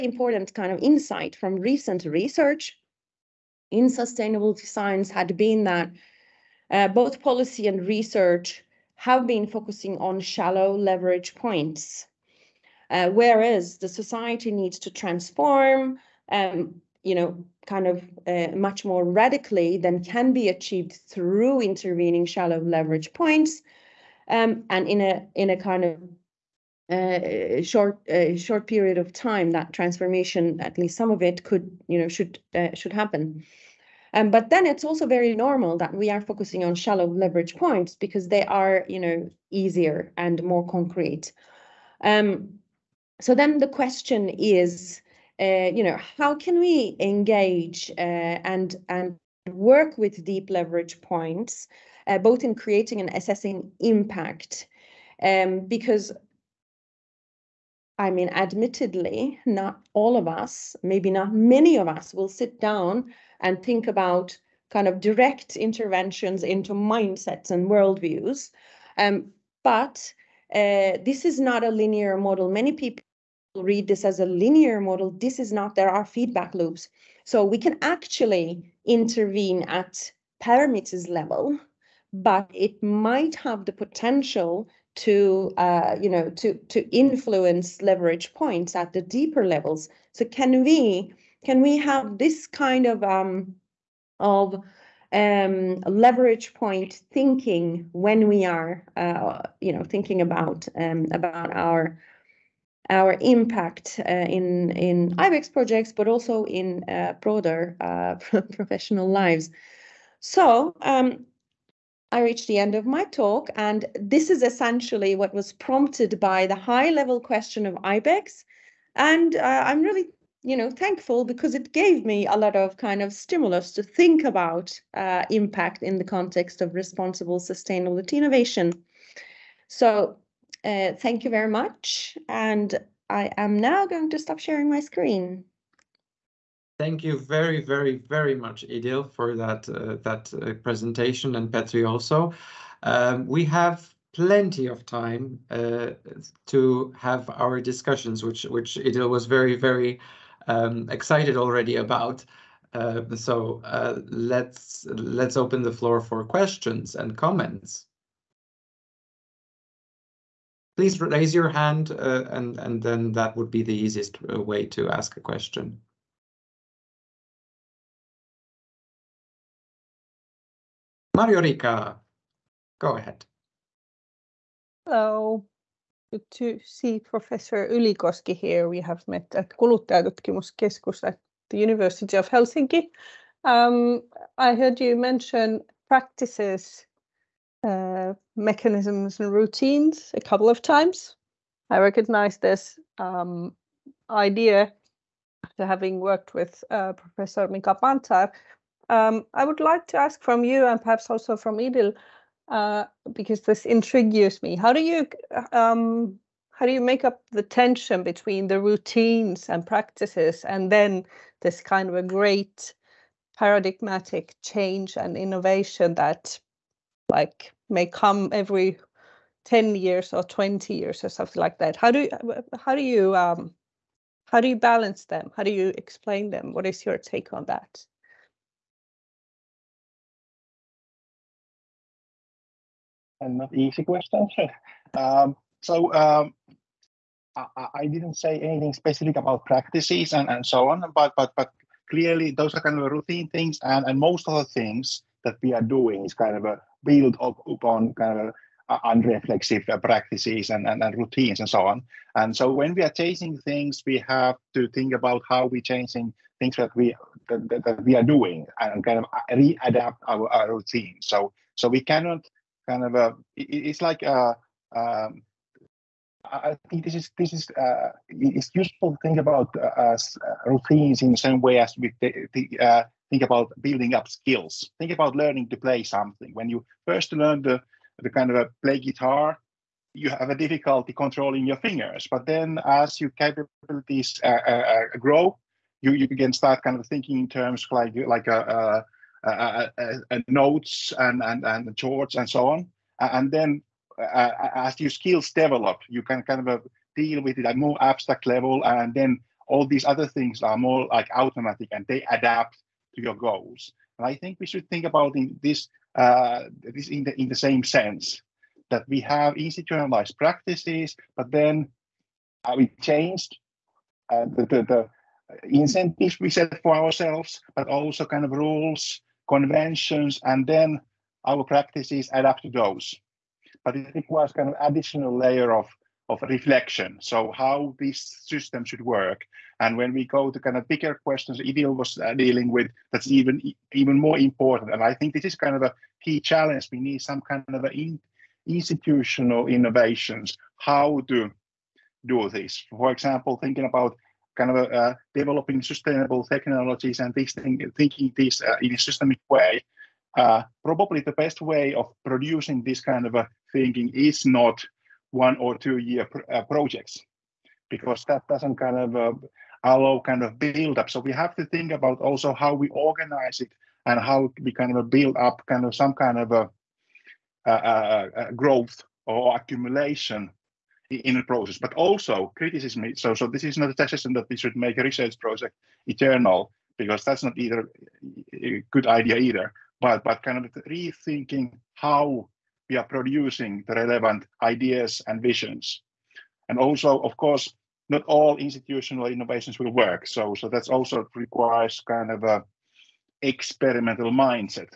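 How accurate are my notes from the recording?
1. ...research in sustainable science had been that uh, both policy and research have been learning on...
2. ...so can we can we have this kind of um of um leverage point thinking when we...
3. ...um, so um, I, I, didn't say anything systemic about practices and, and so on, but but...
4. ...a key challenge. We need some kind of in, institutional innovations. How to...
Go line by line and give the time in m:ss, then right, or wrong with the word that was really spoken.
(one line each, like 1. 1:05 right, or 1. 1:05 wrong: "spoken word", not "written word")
1. 0:02 wrong: "focusing", not "learning"
2. 1:30 right
3. 3:54 wrong: "specific", not "systemic"
4. 5:35 right.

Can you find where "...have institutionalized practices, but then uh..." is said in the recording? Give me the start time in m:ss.
5:08.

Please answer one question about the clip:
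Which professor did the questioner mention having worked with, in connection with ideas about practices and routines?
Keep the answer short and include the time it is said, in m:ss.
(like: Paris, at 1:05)
Mika Pantzar, at 3:17.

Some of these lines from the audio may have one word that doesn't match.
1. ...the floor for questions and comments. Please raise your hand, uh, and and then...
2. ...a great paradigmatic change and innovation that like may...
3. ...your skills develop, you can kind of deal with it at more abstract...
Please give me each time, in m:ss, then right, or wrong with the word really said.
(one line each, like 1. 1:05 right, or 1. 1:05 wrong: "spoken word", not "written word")
1. 2:35 right
2. 3:31 right
3. 4:54 right.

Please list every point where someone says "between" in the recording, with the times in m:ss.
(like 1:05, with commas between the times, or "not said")
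3:28.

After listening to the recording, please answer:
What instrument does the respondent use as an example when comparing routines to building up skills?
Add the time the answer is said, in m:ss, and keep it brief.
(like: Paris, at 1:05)
Guitar, at 4:38.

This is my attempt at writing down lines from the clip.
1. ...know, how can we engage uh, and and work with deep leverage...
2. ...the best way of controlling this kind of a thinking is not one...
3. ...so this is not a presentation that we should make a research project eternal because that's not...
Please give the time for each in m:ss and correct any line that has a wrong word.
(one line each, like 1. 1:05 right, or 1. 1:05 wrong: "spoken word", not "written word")
1. 0:45 right
2. 5:50 wrong: "producing", not "controlling"
3. 6:13 wrong: "suggestion", not "presentation".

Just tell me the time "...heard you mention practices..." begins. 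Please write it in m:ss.
3:04.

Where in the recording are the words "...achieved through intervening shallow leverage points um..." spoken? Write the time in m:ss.
0:20.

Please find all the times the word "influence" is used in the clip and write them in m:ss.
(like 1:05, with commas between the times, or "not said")
1:26.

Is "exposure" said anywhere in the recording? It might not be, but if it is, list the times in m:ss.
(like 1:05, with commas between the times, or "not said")
not said.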